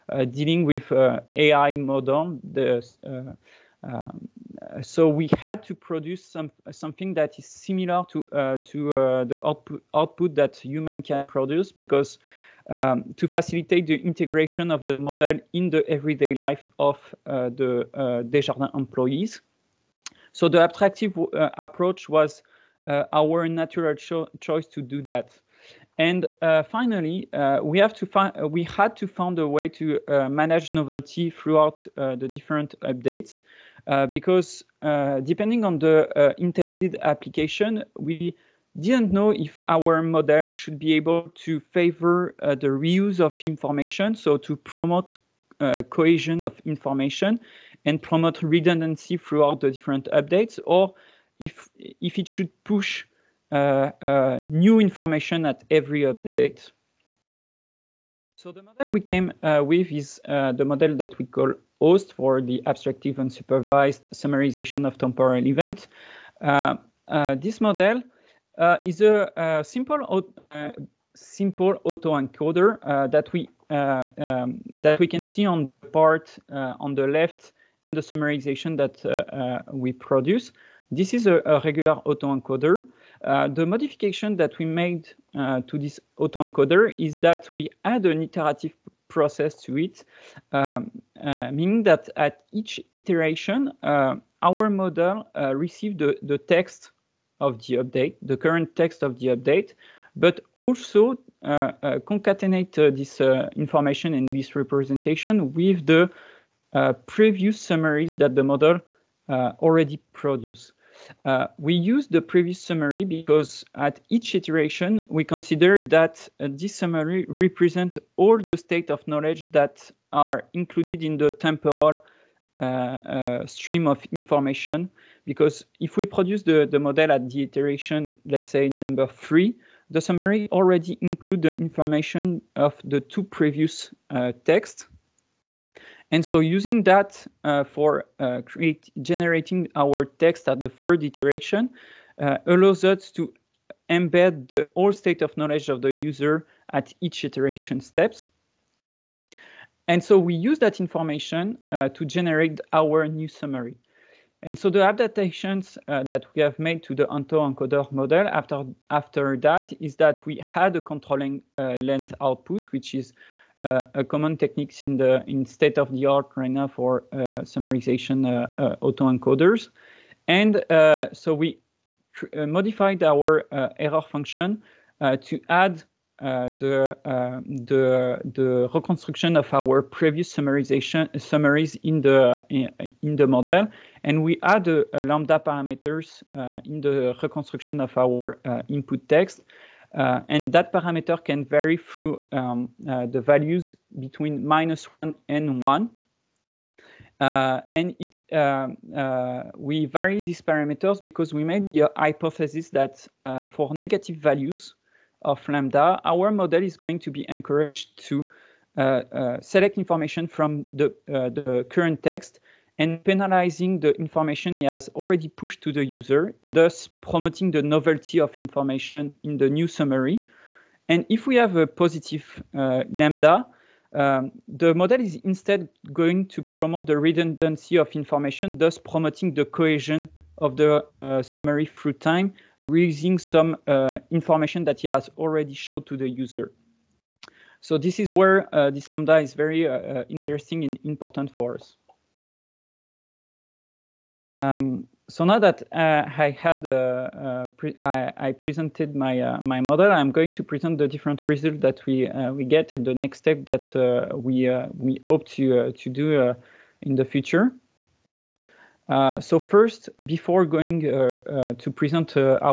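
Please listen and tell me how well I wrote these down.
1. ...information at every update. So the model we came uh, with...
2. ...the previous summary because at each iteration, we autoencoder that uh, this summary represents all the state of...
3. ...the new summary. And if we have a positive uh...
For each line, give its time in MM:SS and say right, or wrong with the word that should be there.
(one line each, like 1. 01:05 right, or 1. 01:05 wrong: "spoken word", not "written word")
1. 00:54 right
2. 01:52 wrong: "consider", not "autoencoder"
3. 03:39 right.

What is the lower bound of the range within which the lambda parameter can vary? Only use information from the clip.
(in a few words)
-1.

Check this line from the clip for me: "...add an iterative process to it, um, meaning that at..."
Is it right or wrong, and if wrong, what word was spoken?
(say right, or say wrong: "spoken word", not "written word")
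right.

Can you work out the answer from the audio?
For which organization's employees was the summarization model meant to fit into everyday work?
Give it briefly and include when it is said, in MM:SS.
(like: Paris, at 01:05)
Desjardins, at 00:18.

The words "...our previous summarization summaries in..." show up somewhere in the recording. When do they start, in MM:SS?
02:59.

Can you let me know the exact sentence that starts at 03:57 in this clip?
So this is where uh, this Lambda is very uh, interesting and important for us.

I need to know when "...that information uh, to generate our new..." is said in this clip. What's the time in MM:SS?
02:30.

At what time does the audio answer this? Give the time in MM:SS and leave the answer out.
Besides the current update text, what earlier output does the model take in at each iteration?
01:47.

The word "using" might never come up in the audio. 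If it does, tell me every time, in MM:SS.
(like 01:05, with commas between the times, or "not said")
02:16, 03:52.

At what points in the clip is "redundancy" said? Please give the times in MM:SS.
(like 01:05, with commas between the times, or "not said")
00:48, 03:46.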